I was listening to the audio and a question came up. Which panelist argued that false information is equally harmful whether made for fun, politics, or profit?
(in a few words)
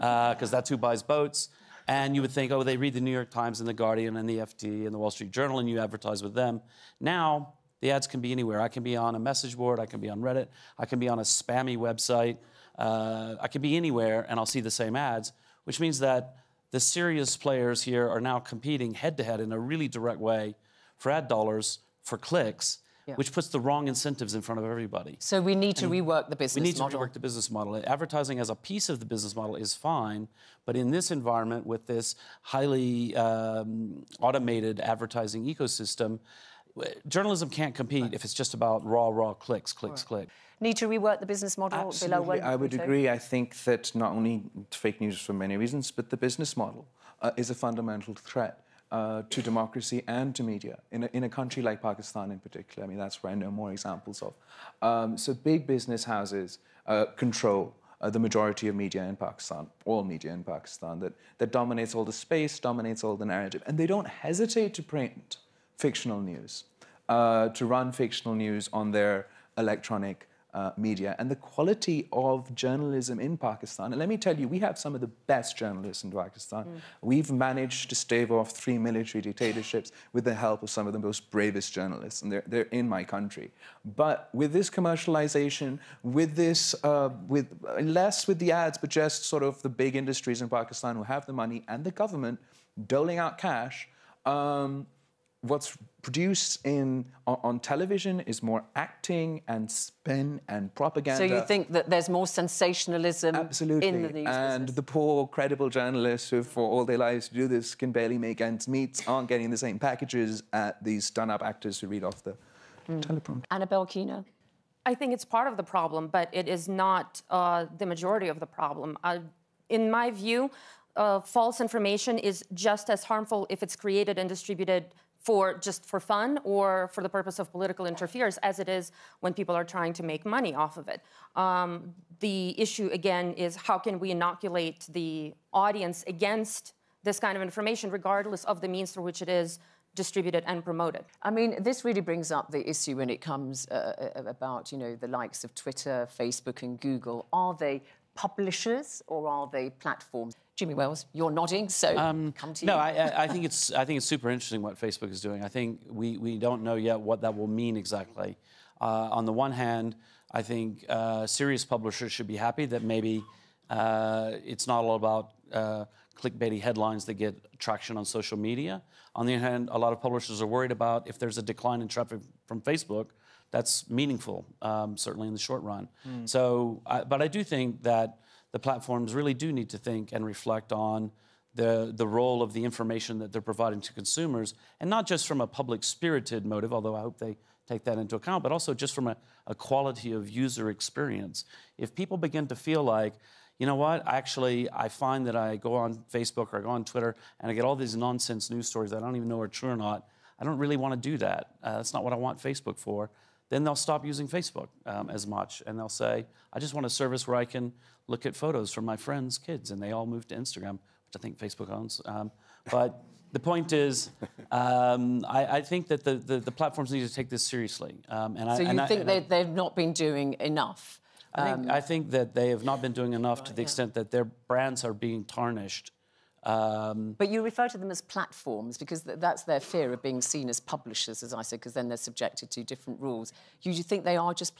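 Anna Belkina.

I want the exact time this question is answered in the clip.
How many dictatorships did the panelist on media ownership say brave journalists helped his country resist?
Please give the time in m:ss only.
1:18.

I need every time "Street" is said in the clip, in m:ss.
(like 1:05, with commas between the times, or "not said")
0:05.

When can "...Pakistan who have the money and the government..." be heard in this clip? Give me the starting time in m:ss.
1:30.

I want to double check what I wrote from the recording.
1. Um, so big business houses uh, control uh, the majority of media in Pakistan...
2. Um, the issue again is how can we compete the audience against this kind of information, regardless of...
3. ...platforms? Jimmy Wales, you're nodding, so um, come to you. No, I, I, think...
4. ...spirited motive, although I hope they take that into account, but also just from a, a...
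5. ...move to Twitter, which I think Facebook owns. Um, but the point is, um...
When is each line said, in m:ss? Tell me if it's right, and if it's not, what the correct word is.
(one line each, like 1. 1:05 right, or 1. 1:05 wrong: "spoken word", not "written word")
1. 0:54 right
2. 2:11 wrong: "inoculate", not "compete"
3. 2:29 right
4. 3:05 right
5. 3:30 wrong: "Instagram", not "Twitter".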